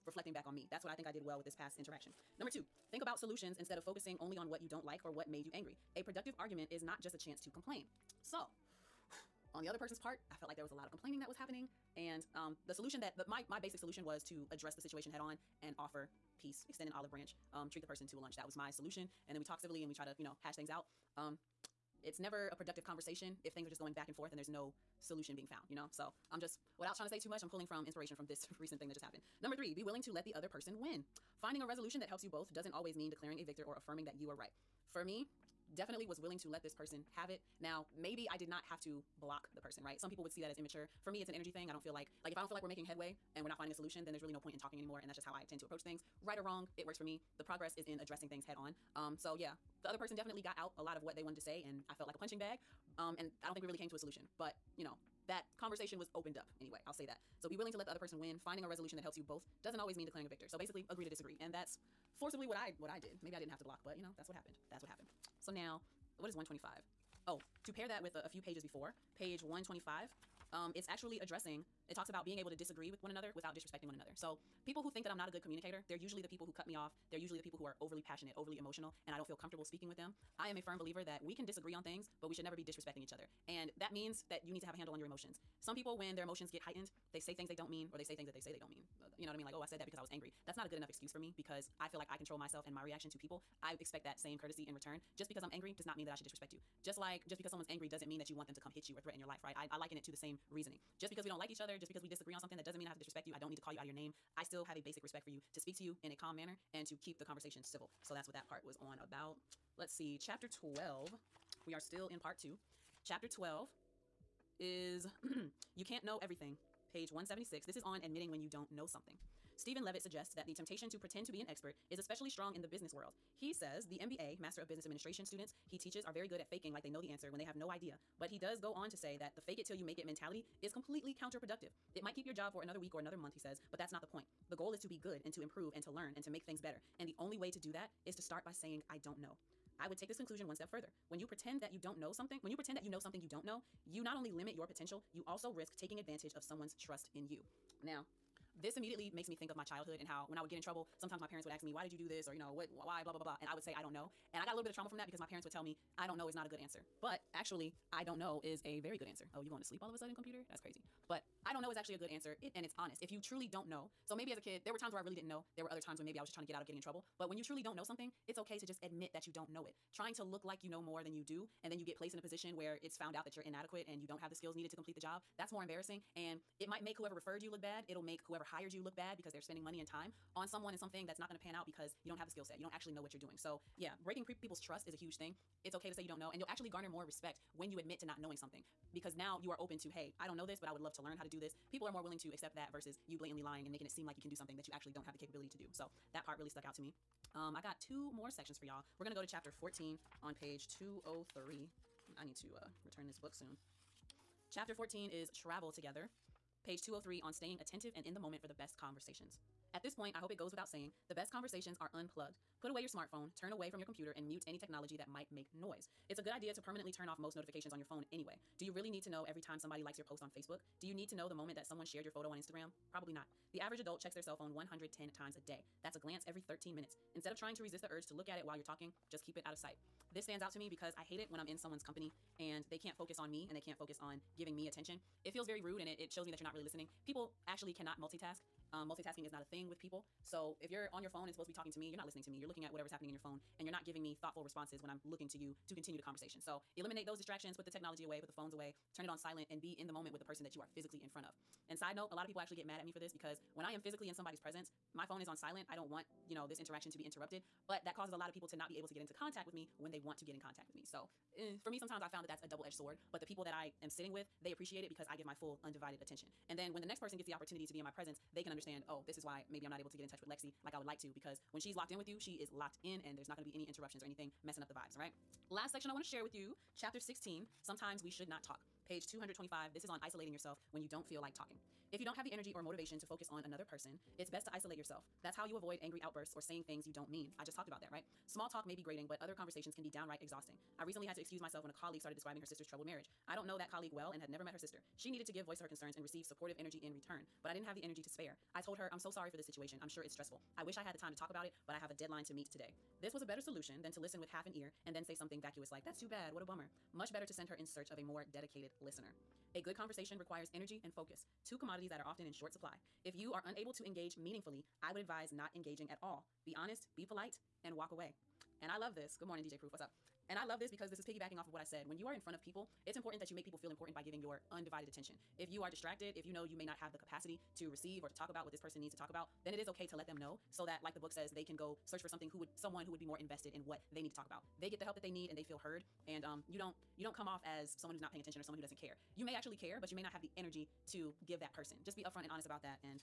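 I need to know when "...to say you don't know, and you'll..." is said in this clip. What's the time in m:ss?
3:05.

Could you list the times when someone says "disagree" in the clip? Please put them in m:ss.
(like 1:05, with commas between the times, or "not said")
1:01, 1:12, 1:21, 1:42.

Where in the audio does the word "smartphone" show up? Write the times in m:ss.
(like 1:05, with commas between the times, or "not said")
3:32.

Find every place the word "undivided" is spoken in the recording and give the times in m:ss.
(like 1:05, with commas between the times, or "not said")
4:25, 5:24.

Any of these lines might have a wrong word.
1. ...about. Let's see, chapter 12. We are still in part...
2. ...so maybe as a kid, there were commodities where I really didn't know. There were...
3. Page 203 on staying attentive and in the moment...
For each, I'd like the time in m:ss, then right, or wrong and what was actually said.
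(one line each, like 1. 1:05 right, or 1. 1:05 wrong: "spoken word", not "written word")
1. 1:48 right
2. 2:44 wrong: "times", not "commodities"
3. 3:26 right.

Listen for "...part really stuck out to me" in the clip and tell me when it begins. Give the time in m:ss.
3:16.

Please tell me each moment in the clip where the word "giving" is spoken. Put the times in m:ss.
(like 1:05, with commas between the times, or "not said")
3:54, 4:03, 5:24.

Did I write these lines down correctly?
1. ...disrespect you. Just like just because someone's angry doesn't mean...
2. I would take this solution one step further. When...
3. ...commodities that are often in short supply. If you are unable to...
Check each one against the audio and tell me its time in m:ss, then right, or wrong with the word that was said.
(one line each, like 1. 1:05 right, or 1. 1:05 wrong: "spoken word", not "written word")
1. 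1:36 right
2. 2:19 wrong: "conclusion", not "solution"
3. 5:11 right.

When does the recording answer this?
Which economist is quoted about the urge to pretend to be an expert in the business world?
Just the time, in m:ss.
1:59.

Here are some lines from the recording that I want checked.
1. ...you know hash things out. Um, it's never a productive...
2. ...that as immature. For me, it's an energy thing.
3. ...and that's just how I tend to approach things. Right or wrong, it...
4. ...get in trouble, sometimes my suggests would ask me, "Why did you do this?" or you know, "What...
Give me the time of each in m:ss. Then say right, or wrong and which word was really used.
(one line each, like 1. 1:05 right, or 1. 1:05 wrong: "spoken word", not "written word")
1. 0:20 right
2. 0:40 right
3. 0:44 right
4. 2:30 wrong: "parents", not "suggests".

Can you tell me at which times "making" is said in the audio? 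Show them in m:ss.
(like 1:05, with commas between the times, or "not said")
0:42, 3:13.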